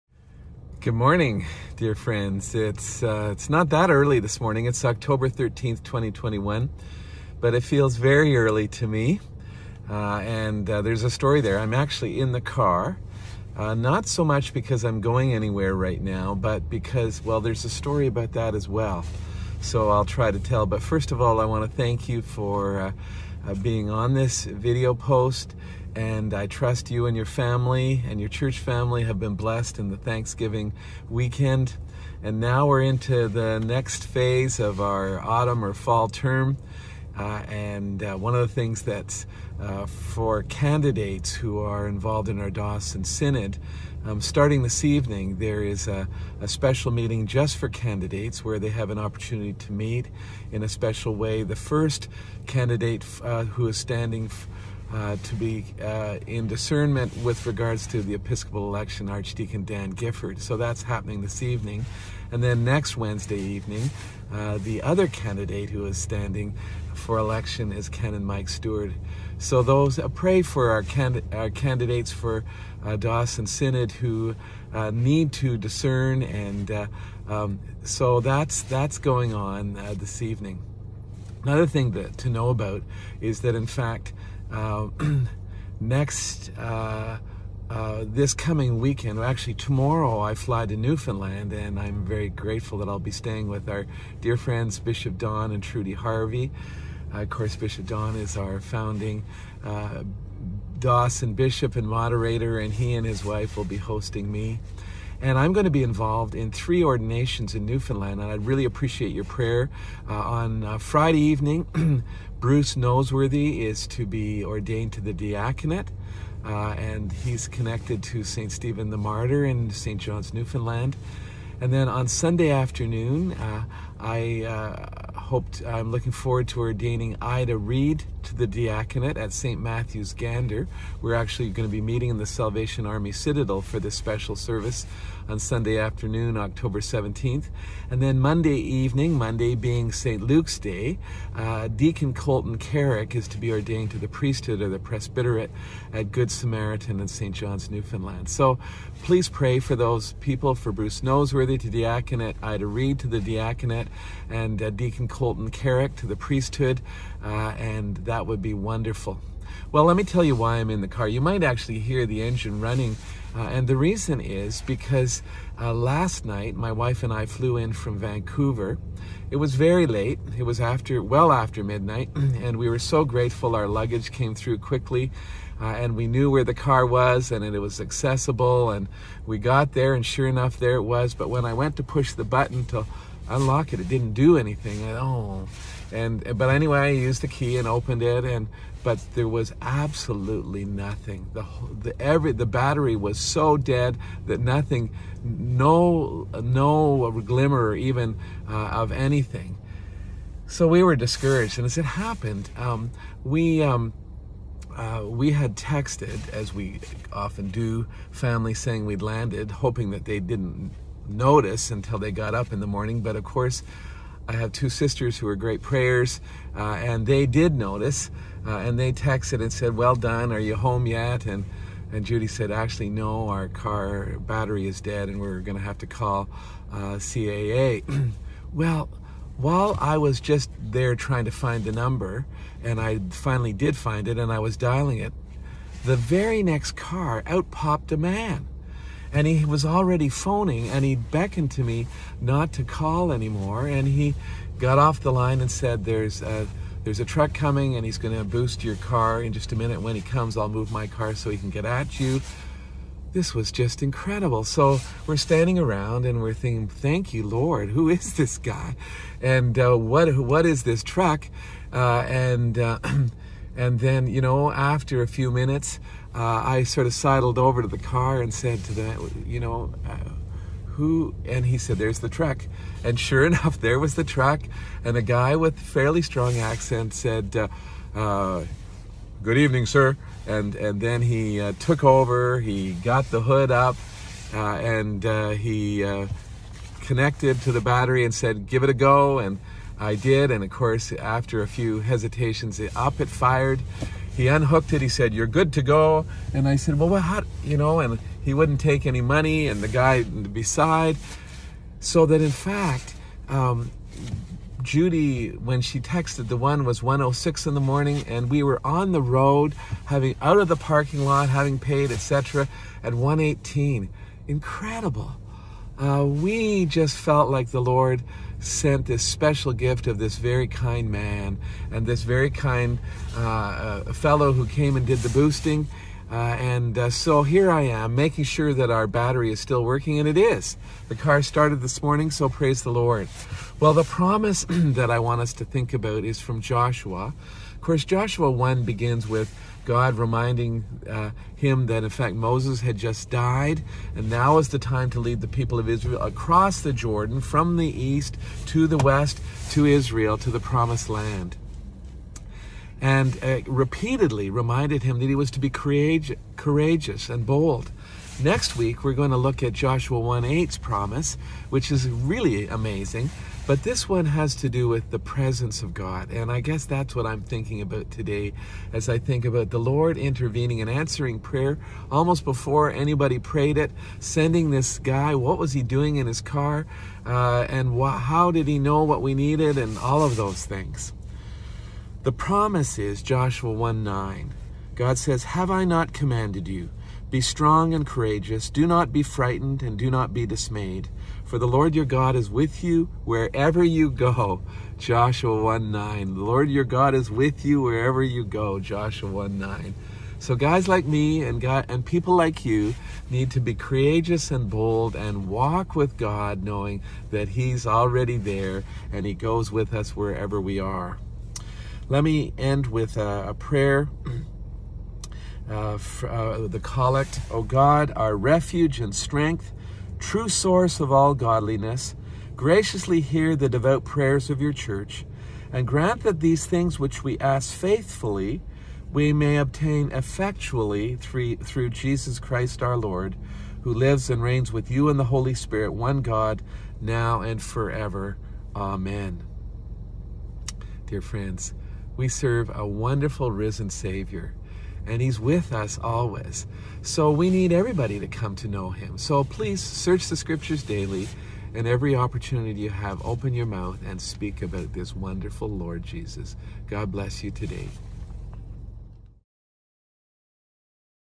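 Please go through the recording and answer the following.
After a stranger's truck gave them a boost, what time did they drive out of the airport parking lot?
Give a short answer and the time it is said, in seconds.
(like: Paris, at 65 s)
1:18, at 312 s.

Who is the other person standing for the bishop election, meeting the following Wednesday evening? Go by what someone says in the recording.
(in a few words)
Mike Stewart.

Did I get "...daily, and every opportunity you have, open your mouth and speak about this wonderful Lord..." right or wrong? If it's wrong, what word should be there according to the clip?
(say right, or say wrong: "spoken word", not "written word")
right.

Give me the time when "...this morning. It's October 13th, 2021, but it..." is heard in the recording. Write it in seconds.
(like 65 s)
4 s.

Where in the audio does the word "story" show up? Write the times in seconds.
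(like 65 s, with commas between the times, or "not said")
11 s, 17 s.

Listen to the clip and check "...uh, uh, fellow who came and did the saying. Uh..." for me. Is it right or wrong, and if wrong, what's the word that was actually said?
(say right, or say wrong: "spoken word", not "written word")
wrong: "boosting", not "saying".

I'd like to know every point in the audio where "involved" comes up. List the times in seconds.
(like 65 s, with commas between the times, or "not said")
41 s, 105 s.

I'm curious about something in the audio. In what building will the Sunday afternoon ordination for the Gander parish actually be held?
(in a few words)
Salvation Army Citadel.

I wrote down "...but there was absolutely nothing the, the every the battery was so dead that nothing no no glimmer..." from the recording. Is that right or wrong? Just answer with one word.
right.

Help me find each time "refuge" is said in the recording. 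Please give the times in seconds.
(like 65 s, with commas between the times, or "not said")
418 s.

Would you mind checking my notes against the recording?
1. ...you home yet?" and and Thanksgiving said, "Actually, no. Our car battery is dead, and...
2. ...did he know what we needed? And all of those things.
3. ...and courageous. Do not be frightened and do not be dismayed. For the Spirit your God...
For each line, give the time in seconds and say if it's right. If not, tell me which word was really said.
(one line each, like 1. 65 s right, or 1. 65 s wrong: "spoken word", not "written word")
1. 220 s wrong: "Judy", not "Thanksgiving"
2. 378 s right
3. 387 s wrong: "Lord", not "Spirit".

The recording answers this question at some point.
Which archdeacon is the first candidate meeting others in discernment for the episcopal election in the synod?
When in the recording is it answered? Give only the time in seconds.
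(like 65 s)
59 s.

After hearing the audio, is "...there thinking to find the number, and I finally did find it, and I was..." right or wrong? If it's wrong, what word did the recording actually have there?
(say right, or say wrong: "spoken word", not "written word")
wrong: "trying", not "thinking".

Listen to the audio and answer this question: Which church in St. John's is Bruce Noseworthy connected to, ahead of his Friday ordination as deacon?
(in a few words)
St. Stephen the Martyr.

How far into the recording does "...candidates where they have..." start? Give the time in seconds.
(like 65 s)
47 s.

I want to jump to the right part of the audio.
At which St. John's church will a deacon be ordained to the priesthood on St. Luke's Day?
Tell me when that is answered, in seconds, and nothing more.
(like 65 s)
146 s.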